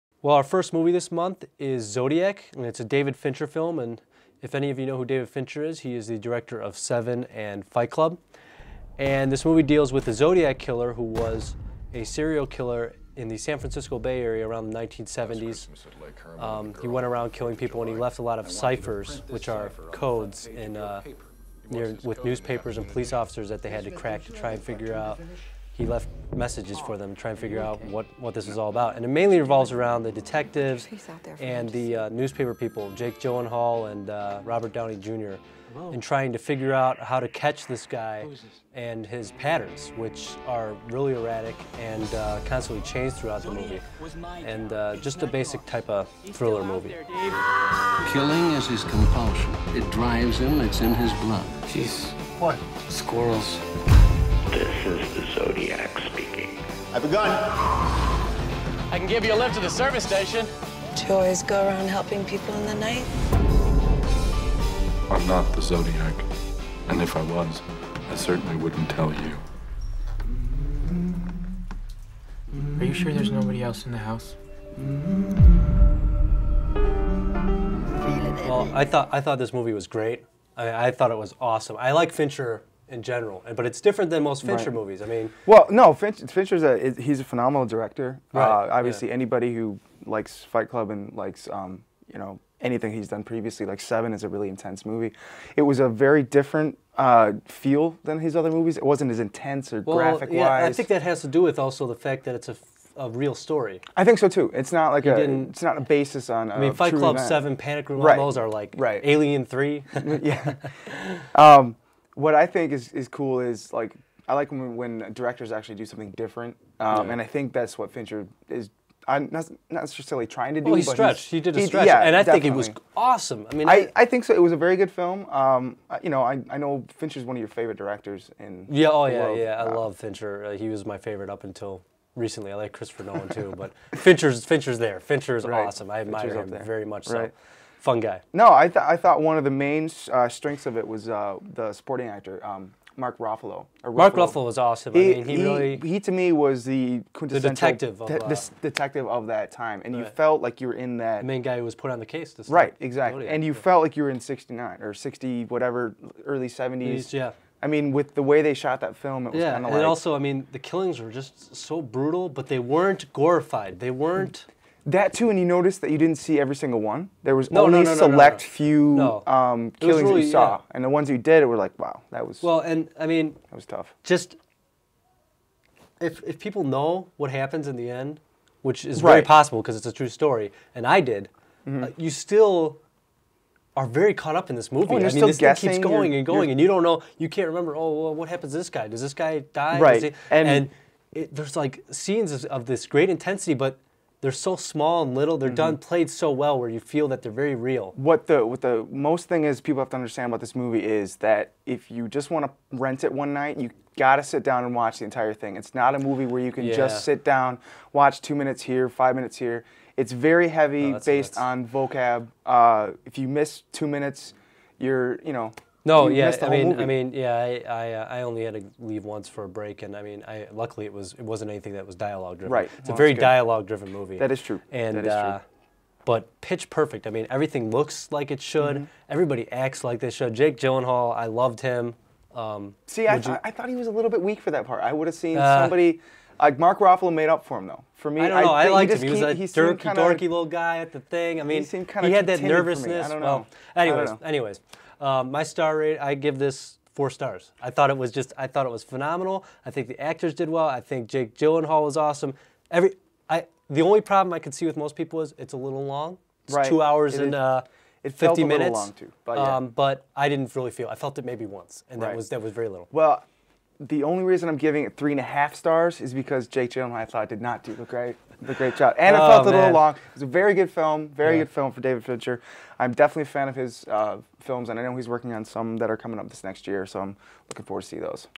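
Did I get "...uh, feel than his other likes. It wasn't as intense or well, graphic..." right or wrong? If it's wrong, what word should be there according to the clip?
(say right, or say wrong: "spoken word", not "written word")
wrong: "movies", not "likes".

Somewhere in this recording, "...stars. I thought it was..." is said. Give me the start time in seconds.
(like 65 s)
247 s.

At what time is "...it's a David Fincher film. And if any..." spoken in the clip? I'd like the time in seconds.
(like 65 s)
2 s.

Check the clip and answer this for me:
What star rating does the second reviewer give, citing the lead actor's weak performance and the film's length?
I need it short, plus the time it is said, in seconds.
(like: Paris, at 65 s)
3.5, at 264 s.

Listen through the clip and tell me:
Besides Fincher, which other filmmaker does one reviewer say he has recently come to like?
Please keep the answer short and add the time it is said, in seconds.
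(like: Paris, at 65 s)
Christopher Nolan, at 132 s.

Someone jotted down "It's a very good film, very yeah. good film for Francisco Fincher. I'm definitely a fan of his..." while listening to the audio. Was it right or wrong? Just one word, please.
wrong.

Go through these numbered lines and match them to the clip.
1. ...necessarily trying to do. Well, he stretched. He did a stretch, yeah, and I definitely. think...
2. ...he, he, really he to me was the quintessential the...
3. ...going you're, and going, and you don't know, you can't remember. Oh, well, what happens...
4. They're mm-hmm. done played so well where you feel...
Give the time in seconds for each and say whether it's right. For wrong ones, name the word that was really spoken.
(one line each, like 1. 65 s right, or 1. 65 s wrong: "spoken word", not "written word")
1. 119 s right
2. 145 s right
3. 185 s right
4. 195 s right.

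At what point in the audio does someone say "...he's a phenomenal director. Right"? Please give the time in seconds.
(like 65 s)
87 s.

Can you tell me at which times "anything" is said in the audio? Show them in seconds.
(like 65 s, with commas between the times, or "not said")
92 s, 221 s.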